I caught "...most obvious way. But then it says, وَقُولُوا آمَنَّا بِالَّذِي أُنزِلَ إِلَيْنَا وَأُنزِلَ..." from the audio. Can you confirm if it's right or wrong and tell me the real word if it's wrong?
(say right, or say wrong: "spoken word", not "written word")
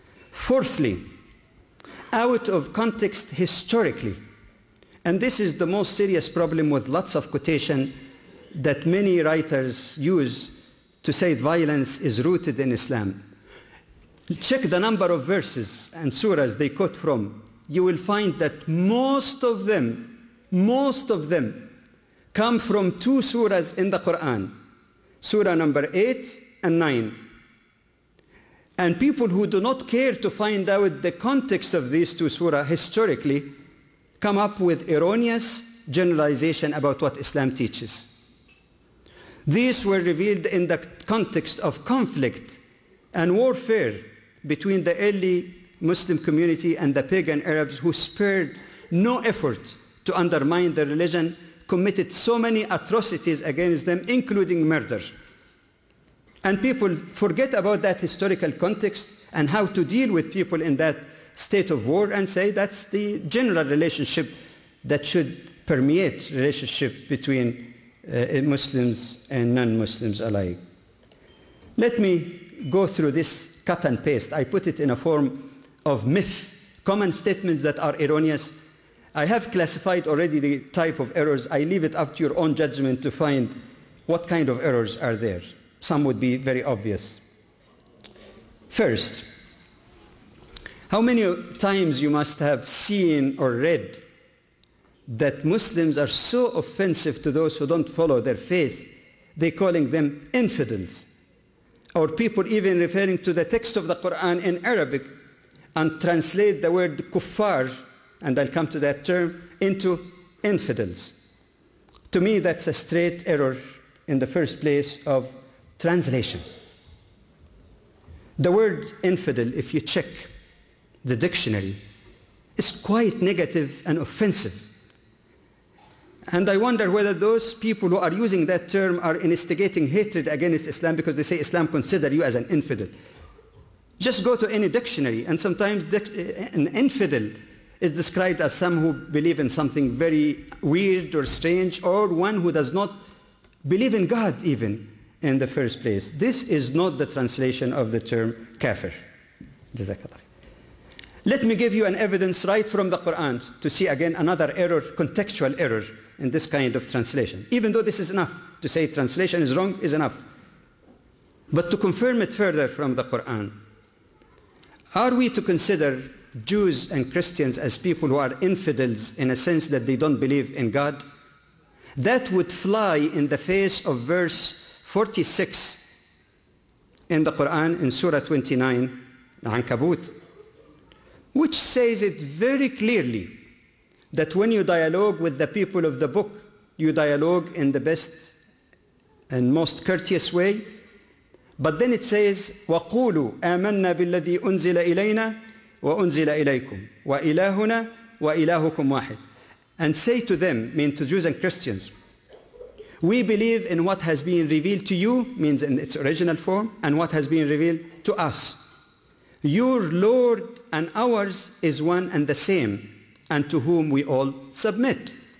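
wrong: "courteous", not "obvious".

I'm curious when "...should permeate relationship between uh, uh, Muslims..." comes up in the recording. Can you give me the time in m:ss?
1:05.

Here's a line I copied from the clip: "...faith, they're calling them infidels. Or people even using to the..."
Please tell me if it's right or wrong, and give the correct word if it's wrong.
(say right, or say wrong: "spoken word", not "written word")
wrong: "referring", not "using".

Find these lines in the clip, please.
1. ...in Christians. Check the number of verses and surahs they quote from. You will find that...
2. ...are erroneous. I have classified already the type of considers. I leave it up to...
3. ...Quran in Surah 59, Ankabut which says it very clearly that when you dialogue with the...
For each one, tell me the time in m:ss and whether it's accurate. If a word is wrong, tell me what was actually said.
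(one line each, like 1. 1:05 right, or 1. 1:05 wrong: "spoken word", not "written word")
1. 0:12 wrong: "Islam", not "Christians"
2. 1:17 wrong: "errors", not "considers"
3. 2:57 wrong: "29", not "59".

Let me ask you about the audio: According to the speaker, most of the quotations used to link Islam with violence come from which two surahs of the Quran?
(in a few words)
8 and 9.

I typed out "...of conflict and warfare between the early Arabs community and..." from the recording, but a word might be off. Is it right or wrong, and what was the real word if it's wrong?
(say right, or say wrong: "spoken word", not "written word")
wrong: "Muslim", not "Arabs".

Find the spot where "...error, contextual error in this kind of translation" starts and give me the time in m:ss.
2:34.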